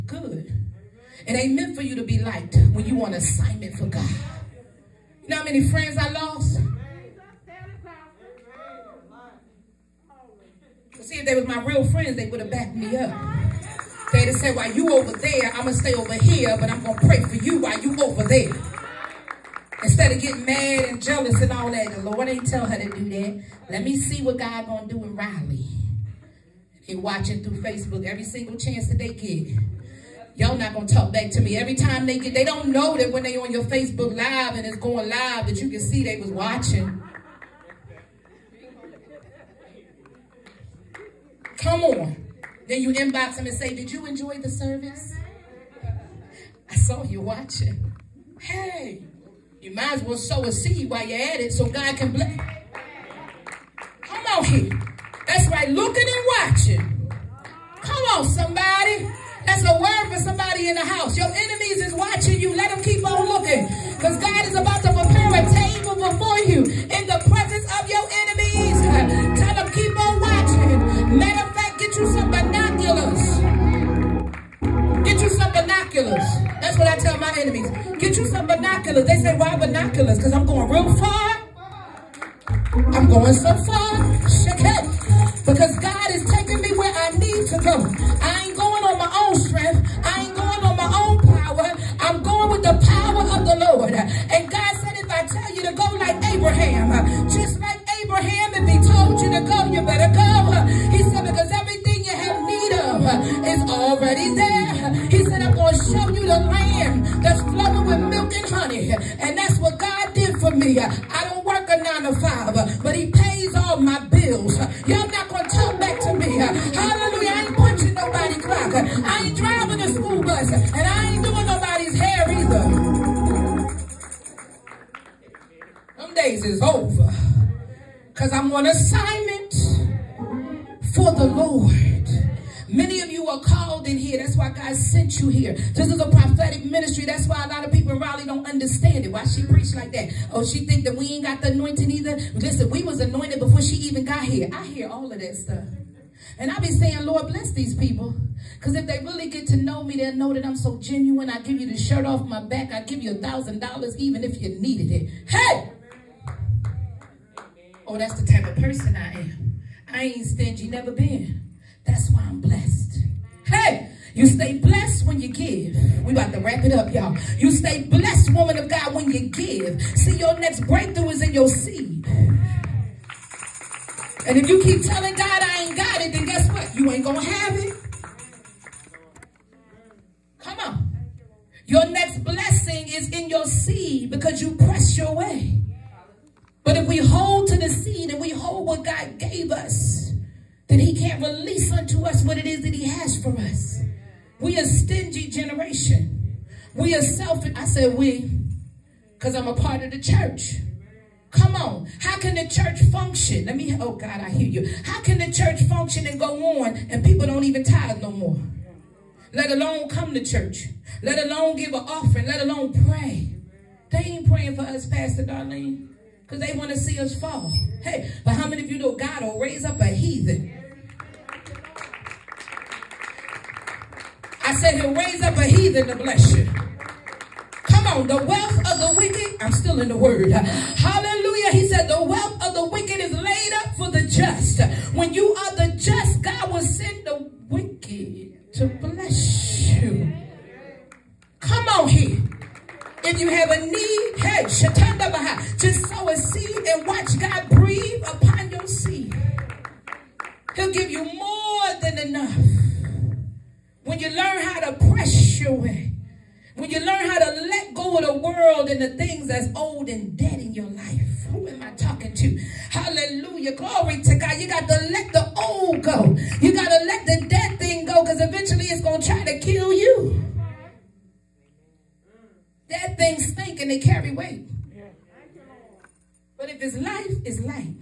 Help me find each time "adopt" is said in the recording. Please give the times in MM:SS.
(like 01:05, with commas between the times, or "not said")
not said.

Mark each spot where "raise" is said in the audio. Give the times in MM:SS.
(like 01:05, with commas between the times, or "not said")
03:39, 03:44.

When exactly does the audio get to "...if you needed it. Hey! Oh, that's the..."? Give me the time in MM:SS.
02:34.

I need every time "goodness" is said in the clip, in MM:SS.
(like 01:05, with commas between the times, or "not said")
not said.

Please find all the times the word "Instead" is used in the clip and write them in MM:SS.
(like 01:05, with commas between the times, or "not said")
00:19.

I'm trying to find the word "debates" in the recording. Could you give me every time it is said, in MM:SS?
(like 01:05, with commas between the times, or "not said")
not said.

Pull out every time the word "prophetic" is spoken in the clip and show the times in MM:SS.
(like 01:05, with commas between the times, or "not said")
02:16.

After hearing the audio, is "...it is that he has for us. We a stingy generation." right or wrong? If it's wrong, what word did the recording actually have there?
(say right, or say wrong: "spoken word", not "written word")
right.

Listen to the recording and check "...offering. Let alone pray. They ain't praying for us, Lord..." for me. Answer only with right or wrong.
wrong.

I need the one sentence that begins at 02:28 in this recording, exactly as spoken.
Because if they really get to know me, they'll know that I'm so genuine.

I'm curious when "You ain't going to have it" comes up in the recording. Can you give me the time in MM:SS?
02:56.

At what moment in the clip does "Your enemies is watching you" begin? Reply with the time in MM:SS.
01:01.